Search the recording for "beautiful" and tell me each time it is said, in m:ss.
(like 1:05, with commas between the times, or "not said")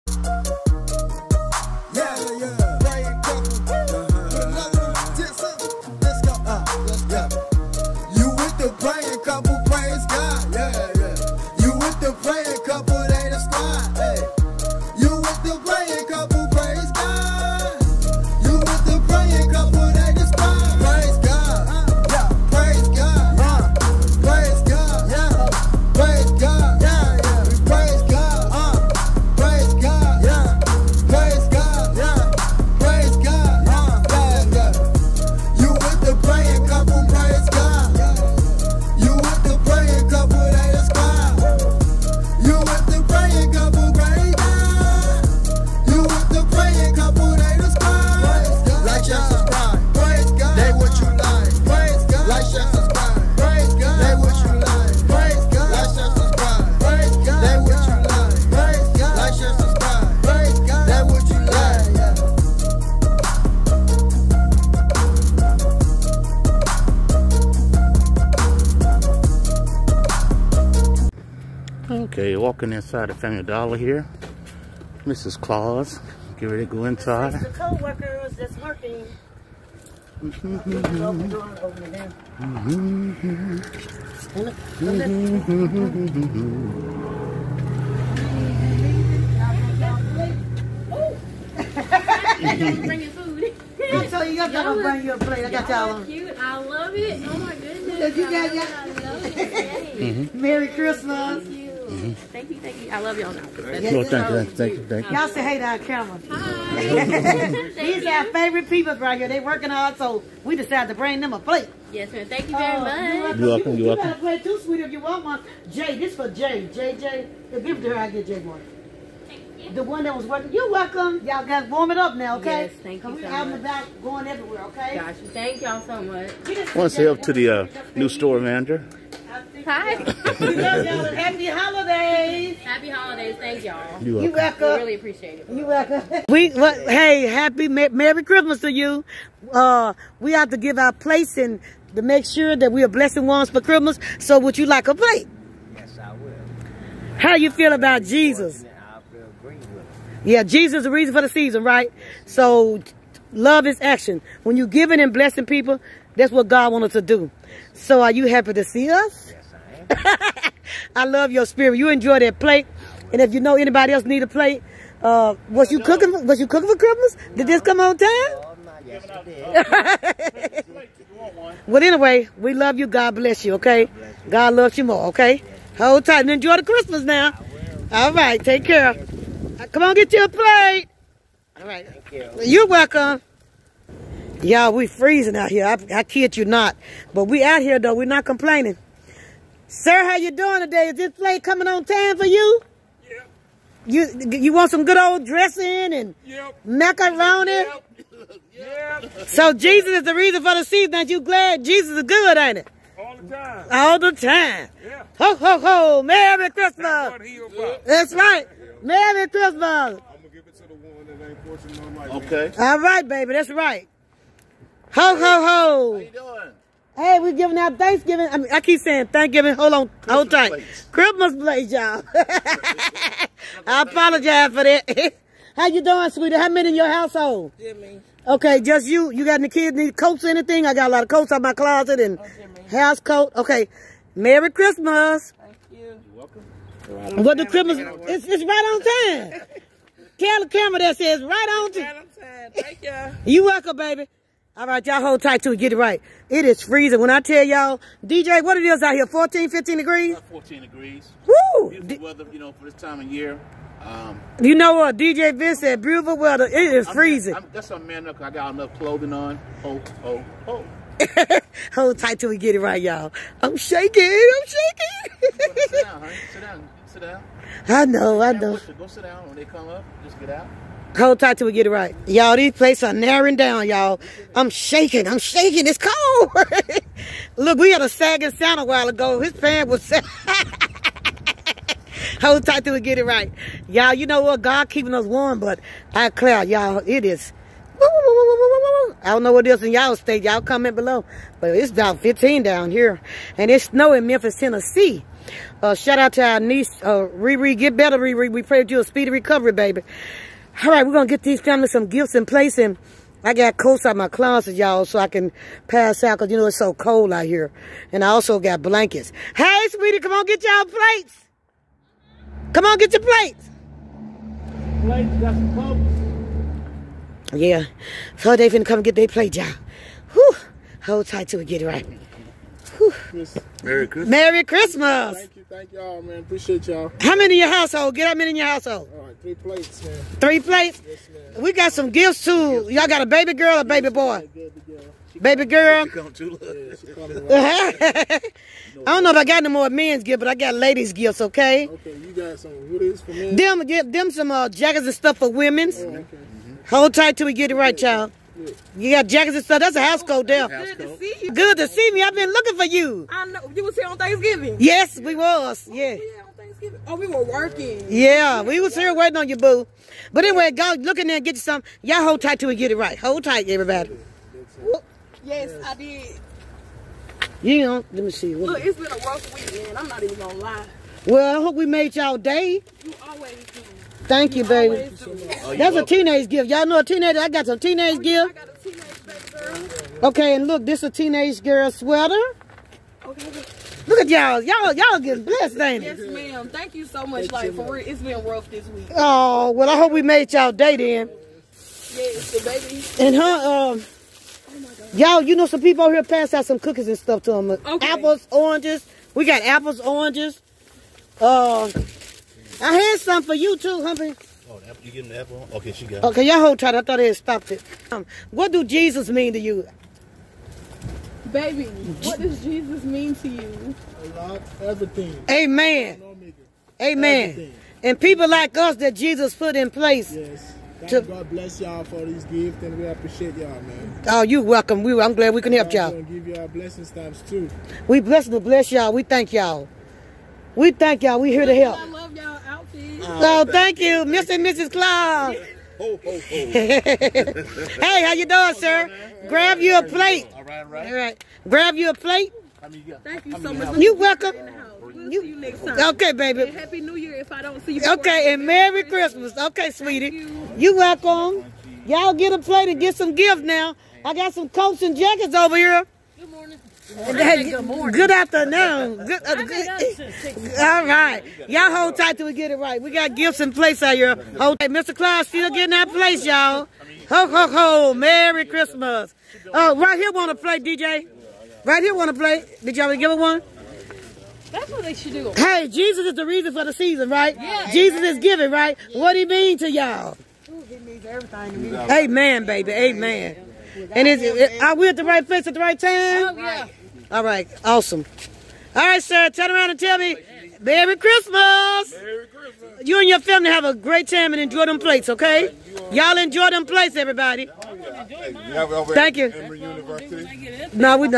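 4:11, 4:15.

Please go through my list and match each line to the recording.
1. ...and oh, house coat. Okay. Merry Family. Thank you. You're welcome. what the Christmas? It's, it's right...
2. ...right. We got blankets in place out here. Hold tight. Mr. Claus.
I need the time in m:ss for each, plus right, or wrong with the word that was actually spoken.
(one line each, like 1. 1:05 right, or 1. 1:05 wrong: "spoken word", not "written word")
1. 3:51 wrong: "Christmas", not "Family"
2. 7:42 wrong: "gifts", not "blankets".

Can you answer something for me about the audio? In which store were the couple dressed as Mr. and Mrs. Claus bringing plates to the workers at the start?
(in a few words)
Family Dollar.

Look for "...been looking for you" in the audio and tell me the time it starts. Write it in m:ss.
5:52.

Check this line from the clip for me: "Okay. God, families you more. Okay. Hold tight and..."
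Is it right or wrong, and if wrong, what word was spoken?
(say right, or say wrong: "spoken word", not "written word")
wrong: "loves", not "families".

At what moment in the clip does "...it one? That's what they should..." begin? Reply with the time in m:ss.
7:53.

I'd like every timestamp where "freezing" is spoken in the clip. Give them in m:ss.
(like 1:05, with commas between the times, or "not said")
3:04, 4:06, 4:16.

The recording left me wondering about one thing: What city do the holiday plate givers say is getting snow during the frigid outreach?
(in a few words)
Memphis, Tennessee.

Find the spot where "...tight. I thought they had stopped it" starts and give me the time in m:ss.
6:46.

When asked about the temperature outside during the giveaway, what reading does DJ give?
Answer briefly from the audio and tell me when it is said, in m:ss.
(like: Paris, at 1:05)
14 degrees, at 4:10.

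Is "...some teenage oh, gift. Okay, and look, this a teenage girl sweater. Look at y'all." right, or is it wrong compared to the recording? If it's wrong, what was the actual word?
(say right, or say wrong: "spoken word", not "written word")
right.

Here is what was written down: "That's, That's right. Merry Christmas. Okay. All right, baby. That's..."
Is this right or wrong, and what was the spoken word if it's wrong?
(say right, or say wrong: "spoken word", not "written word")
right.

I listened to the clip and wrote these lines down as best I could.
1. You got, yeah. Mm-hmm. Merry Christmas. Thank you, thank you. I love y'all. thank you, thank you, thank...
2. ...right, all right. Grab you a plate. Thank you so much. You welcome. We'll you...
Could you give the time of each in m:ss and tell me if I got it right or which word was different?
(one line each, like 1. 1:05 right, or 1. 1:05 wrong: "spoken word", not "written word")
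1. 1:38 right
2. 7:20 right.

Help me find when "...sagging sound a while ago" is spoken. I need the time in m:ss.
4:37.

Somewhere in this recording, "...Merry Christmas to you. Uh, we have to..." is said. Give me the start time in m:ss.
2:17.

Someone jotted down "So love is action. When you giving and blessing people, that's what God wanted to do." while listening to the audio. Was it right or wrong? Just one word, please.
right.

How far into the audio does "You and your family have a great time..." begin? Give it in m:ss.
8:12.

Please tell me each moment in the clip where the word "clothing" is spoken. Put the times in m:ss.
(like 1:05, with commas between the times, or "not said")
4:18.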